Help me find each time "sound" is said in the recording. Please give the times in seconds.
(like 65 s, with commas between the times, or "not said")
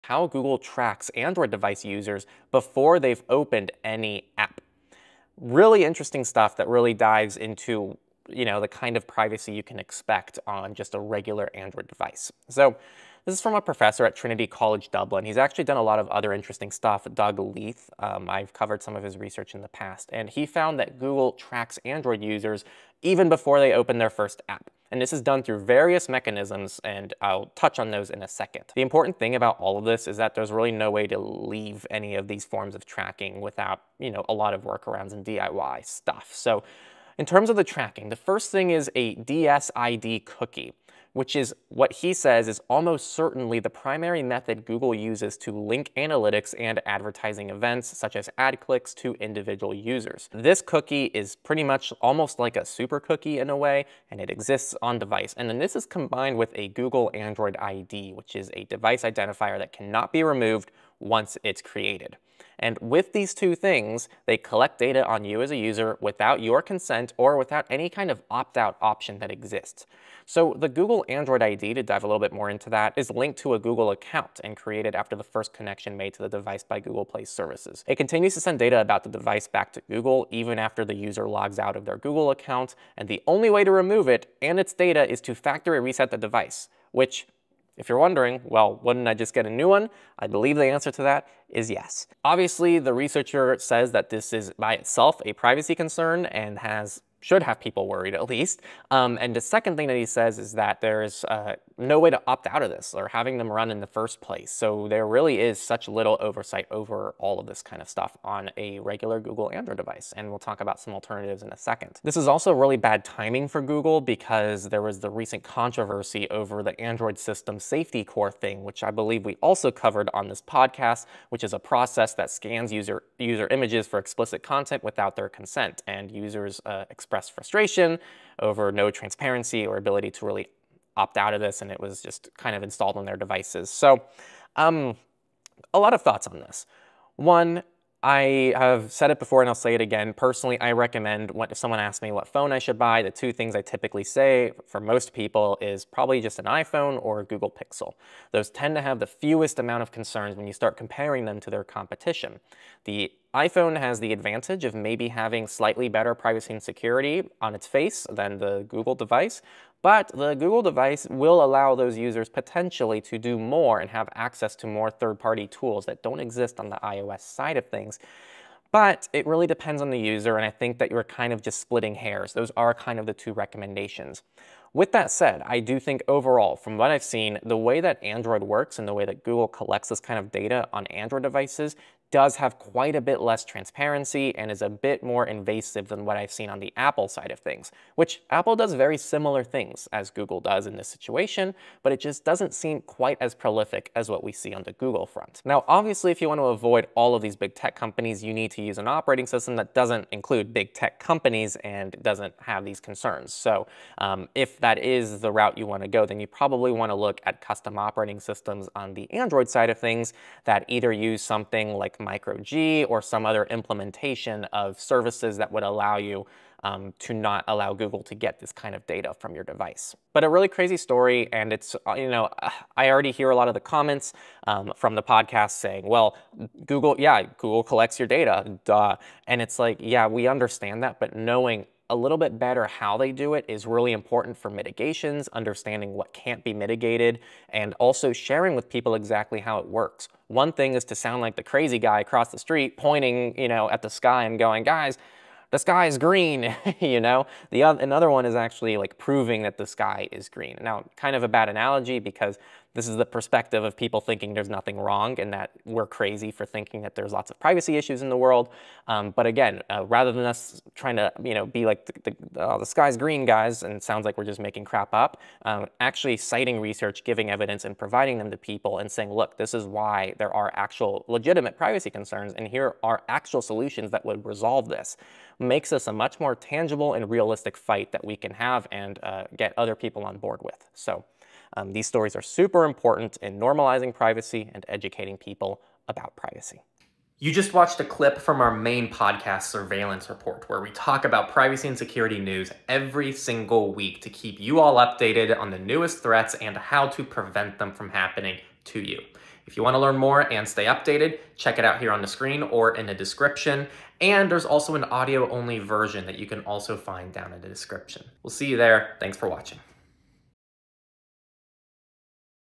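240 s, 263 s.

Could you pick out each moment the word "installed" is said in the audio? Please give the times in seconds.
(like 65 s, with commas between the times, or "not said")
132 s.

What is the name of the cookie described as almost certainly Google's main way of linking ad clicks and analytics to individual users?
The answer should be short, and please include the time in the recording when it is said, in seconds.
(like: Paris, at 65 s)
DSID, at 39 s.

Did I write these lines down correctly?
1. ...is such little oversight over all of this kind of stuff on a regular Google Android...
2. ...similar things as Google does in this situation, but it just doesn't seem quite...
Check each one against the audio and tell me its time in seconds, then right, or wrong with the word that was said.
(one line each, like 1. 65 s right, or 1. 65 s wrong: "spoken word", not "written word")
1. 105 s right
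2. 188 s right.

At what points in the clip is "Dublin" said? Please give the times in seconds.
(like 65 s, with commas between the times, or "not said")
14 s.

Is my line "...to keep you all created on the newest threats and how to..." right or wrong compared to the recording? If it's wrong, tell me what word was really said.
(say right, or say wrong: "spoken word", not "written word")
wrong: "updated", not "created".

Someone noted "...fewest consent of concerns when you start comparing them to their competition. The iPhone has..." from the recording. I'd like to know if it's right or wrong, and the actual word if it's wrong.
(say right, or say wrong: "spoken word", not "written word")
wrong: "amount", not "consent".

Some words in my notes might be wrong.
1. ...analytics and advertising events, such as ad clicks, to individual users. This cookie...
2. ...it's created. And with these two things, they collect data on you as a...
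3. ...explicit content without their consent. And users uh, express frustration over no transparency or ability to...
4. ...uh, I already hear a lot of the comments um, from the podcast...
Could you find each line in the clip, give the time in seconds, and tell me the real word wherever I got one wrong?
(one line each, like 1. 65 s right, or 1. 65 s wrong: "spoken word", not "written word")
1. 45 s right
2. 61 s right
3. 123 s right
4. 222 s right.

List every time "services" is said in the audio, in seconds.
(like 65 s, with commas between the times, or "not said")
77 s, 214 s.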